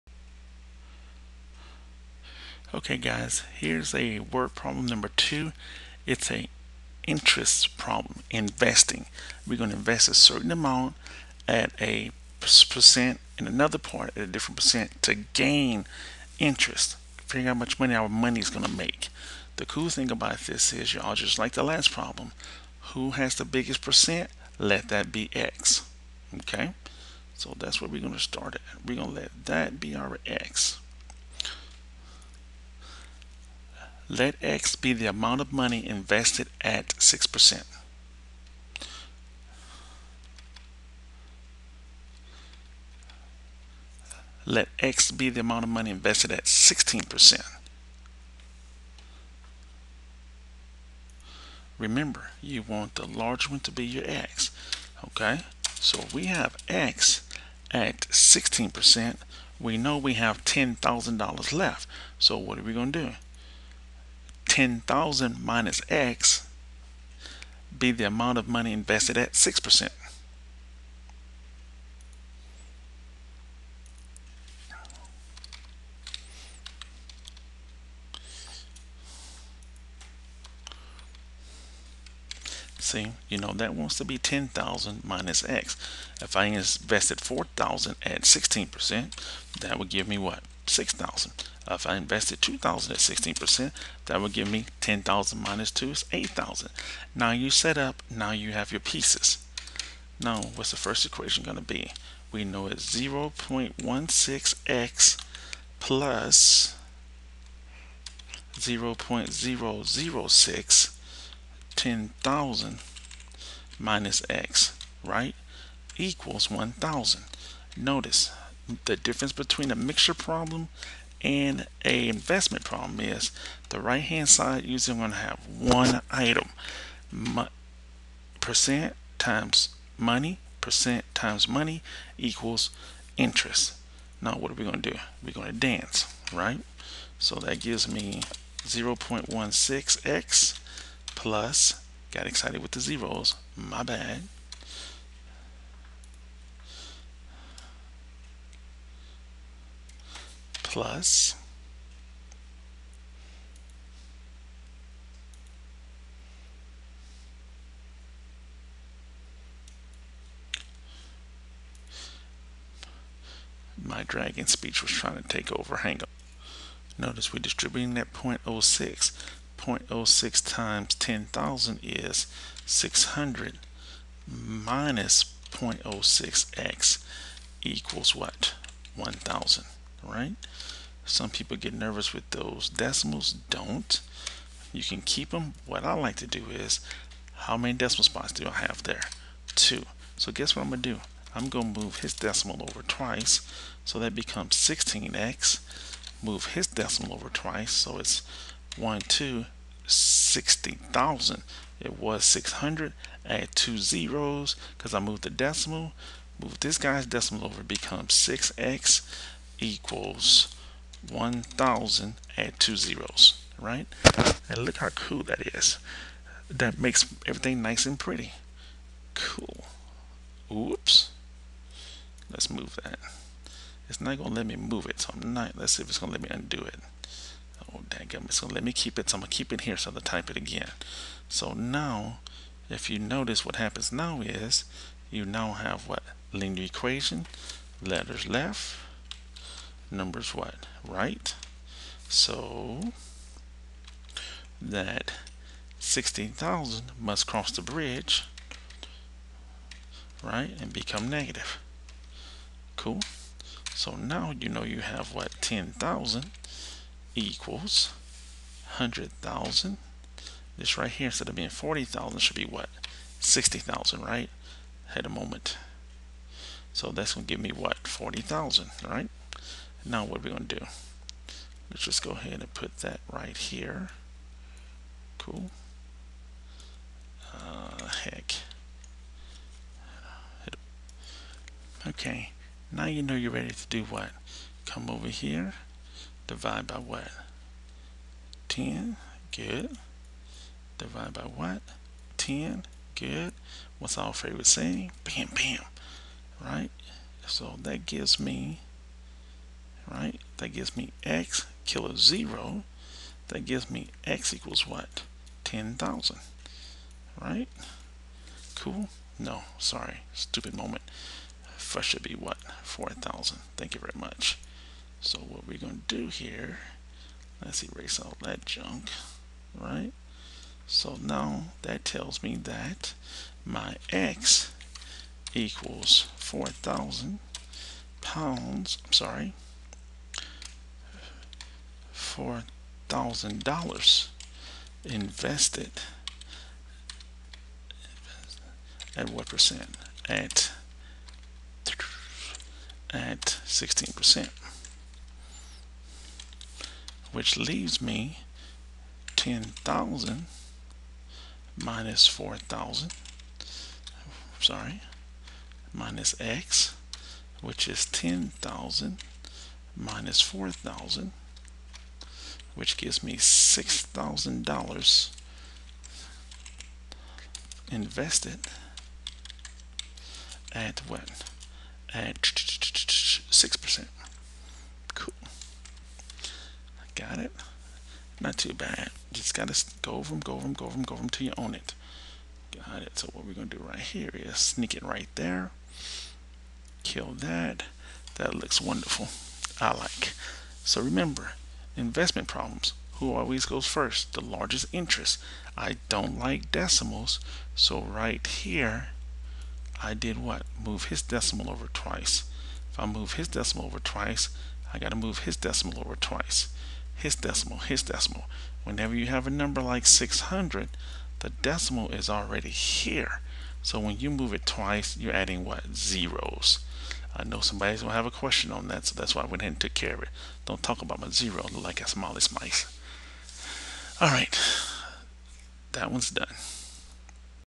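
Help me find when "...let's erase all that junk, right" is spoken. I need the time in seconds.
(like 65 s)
317 s.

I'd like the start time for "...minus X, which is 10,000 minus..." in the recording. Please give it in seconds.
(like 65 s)
355 s.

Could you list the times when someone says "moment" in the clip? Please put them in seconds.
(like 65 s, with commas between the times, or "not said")
265 s, 310 s.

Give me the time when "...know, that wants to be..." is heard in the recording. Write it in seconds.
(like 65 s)
83 s.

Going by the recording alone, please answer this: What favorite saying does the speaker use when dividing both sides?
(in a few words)
Bam, bam.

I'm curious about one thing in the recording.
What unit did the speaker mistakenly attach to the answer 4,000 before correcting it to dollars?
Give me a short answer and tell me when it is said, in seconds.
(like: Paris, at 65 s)
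pounds, at 326 s.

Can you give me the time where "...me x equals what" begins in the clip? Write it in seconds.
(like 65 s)
303 s.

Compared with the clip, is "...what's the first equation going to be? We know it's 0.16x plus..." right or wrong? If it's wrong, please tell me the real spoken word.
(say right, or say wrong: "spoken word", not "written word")
right.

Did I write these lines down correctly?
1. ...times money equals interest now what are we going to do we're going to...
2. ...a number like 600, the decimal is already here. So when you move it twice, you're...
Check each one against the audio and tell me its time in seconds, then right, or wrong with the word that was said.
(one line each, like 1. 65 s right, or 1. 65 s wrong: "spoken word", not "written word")
1. 131 s right
2. 409 s right.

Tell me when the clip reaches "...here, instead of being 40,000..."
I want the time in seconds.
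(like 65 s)
260 s.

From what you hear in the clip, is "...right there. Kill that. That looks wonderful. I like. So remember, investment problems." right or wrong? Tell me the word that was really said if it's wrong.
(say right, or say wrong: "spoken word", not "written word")
right.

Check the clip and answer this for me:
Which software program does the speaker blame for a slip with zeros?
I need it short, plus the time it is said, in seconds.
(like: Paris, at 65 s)
dragon speech, at 163 s.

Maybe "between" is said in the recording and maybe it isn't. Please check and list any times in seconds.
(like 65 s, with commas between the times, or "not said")
119 s.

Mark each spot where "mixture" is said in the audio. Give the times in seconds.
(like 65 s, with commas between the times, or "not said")
119 s.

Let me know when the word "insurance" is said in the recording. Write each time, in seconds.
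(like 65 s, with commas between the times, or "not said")
not said.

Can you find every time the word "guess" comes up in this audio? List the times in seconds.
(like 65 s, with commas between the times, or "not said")
190 s.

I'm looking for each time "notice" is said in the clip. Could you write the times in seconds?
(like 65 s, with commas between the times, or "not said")
117 s, 166 s, 232 s.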